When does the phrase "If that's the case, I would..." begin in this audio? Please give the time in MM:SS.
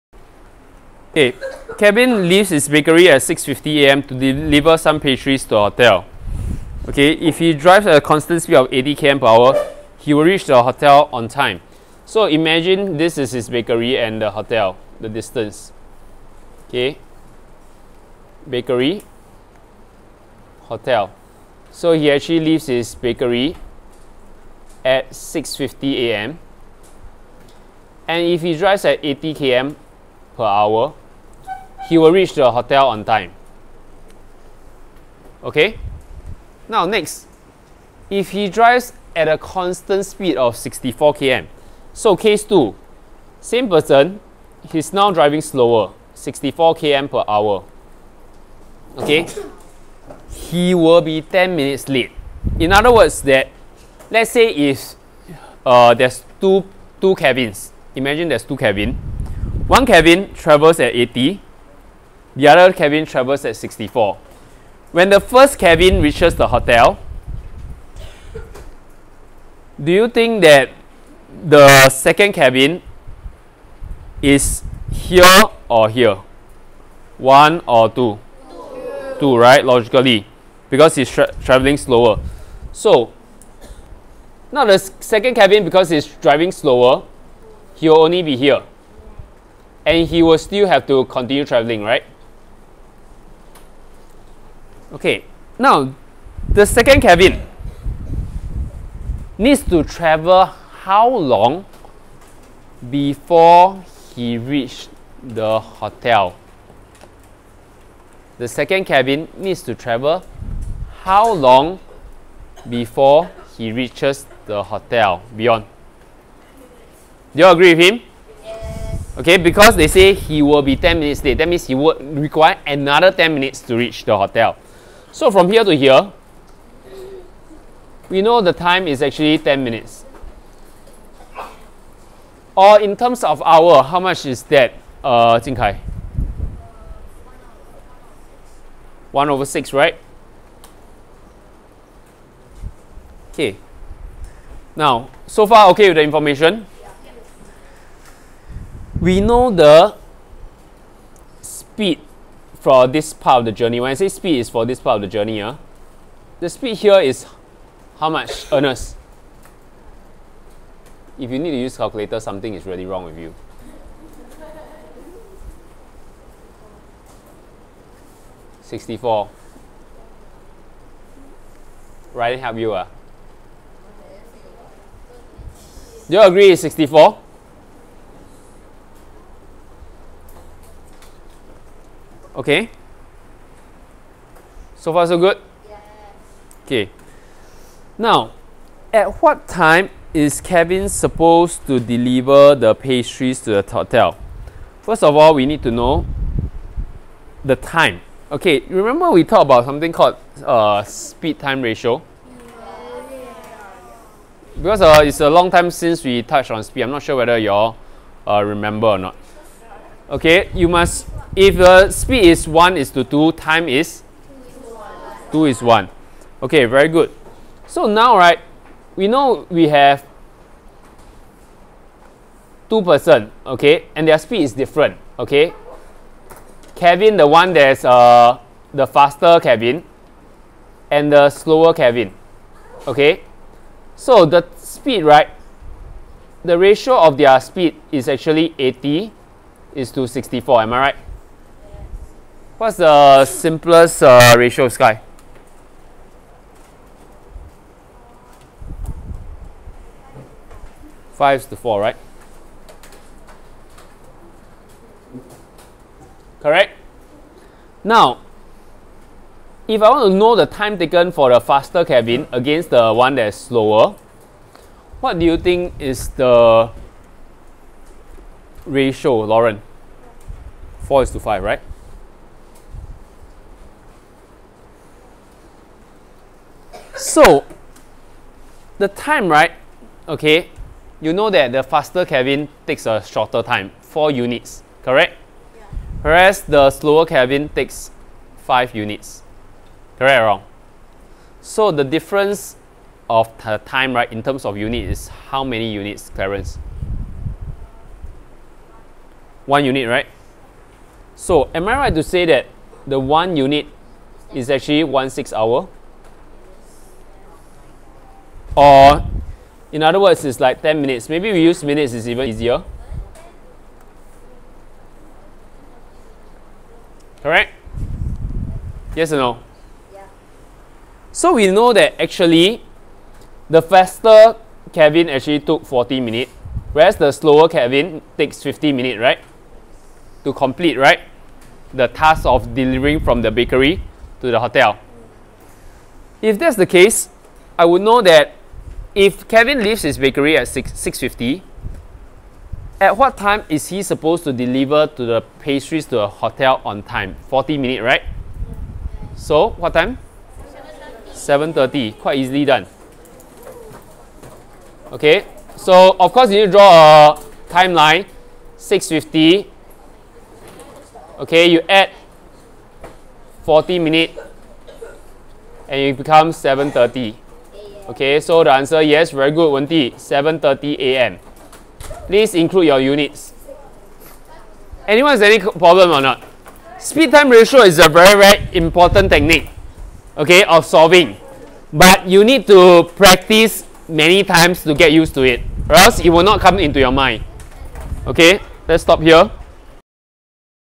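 05:36.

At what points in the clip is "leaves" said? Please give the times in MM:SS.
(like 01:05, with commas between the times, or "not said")
00:02, 00:22, 05:39.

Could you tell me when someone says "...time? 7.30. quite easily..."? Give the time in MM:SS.
05:49.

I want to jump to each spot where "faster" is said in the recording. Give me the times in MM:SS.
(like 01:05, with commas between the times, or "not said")
03:48, 04:21, 04:41, 05:23.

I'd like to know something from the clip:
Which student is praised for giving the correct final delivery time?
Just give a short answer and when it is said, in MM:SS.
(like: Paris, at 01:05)
Wendy, at 06:09.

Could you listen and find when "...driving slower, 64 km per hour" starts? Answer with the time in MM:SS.
00:45.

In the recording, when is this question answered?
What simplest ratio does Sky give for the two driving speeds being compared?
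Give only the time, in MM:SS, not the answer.
04:11.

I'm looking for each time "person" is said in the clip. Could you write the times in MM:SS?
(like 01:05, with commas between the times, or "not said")
00:43, 03:42.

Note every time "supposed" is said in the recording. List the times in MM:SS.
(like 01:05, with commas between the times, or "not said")
03:10, 05:43.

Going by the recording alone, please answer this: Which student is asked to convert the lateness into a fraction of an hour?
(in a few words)
Jing Kai.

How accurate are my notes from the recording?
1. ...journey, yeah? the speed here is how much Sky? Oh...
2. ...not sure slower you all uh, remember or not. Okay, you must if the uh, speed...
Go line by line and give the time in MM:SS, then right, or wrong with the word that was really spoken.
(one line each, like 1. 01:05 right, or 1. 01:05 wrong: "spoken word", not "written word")
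1. 02:35 wrong: "Ernest", not "Sky"
2. 03:26 wrong: "whether", not "slower".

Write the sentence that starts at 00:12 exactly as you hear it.
So imagine this is his bakery and the hotel, the distance.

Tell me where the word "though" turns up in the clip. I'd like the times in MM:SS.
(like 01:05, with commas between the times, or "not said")
not said.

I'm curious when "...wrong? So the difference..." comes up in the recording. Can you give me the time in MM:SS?
04:50.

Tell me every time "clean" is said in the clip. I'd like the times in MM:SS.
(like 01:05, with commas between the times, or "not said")
not said.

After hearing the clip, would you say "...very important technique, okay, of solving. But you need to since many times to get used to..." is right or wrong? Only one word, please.
wrong.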